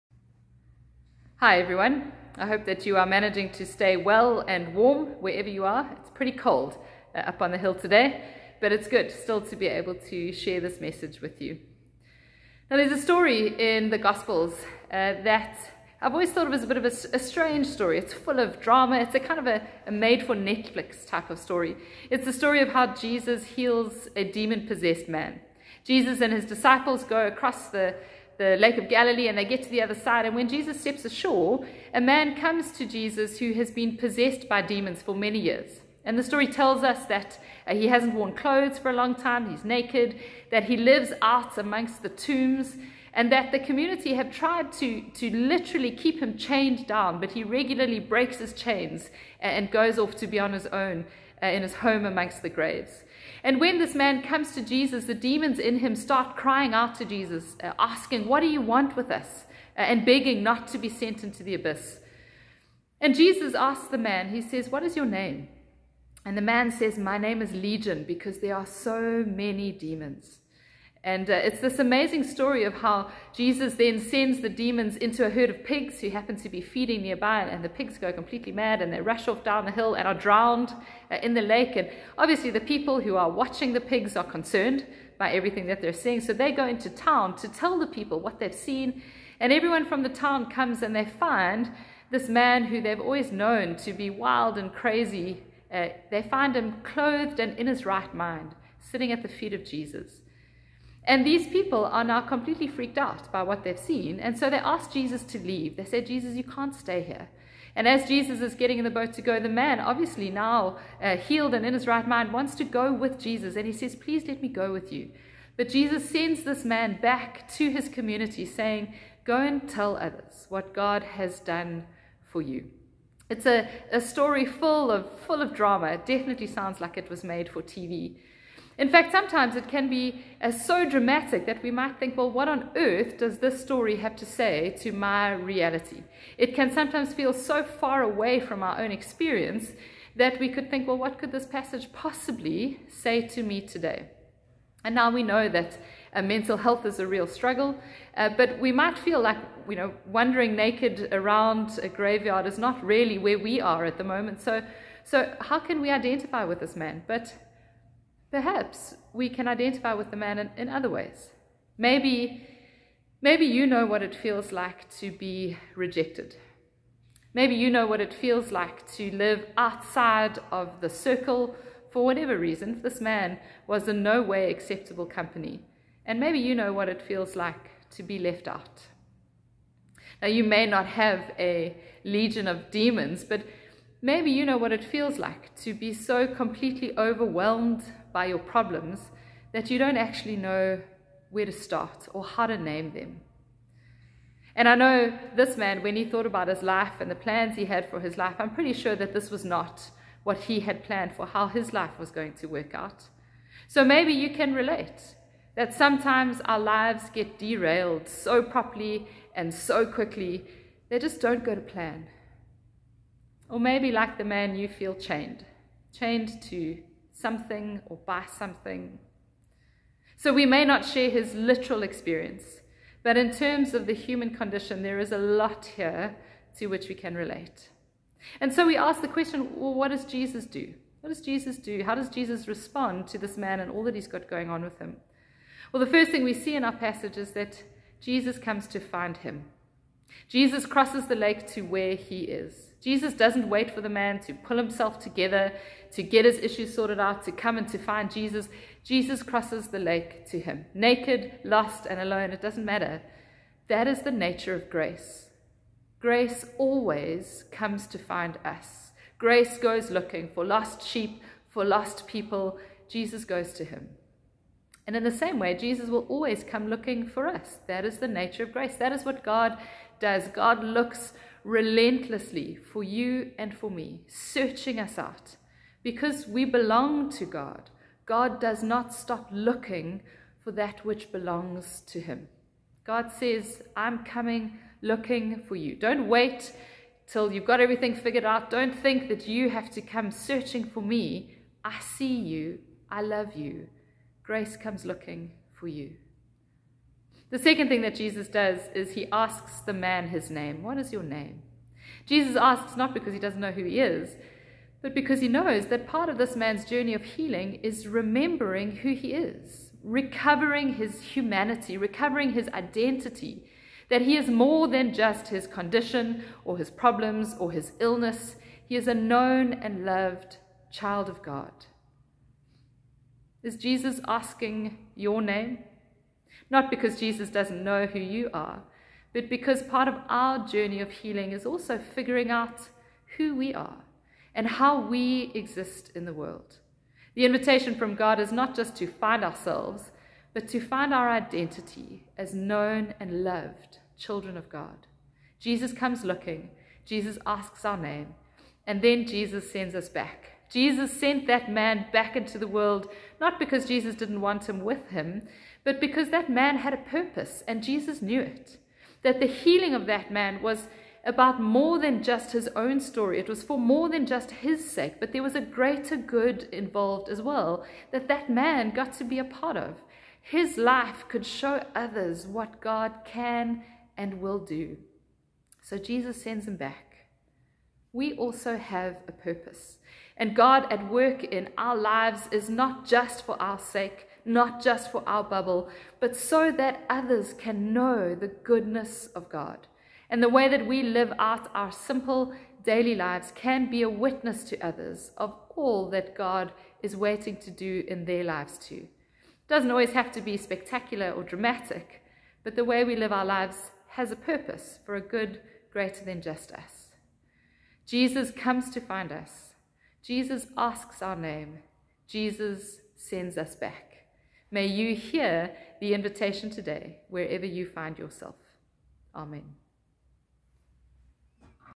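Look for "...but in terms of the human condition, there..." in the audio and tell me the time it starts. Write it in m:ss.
3:43.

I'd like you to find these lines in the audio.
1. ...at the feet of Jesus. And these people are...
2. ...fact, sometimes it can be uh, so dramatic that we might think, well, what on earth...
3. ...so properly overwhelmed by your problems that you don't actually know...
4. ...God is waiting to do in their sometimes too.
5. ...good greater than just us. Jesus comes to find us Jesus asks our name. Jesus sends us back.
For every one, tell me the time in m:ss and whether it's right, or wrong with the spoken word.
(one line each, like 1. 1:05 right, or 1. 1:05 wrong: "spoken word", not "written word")
1. 1:39 right
2. 2:08 right
3. 3:05 wrong: "completely", not "properly"
4. 6:36 wrong: "lives", not "sometimes"
5. 6:45 right.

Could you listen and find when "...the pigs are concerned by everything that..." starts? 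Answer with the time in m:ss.
1:23.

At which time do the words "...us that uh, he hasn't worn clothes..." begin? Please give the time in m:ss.
0:36.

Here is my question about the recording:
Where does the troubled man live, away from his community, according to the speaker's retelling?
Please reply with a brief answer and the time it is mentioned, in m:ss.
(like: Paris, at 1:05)
amongst the tombs, at 0:41.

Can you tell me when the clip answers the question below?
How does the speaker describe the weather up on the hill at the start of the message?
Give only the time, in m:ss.
0:06.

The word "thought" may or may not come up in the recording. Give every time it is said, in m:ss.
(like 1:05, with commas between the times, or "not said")
0:16, 3:16.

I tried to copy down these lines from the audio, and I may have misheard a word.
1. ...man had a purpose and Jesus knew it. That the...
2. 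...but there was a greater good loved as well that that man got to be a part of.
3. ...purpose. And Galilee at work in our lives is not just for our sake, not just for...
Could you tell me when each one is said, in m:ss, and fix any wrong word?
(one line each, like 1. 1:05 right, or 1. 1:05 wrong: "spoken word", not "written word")
1. 5:56 right
2. 6:04 wrong: "involved", not "loved"
3. 6:19 wrong: "God", not "Galilee".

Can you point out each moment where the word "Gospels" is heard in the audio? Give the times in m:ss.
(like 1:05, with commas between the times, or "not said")
0:13.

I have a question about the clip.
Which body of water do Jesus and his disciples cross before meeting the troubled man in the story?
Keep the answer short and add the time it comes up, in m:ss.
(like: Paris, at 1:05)
Lake of Galilee, at 0:28.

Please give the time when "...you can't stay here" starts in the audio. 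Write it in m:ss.
1:46.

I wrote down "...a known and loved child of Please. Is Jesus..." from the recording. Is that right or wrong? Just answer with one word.
wrong.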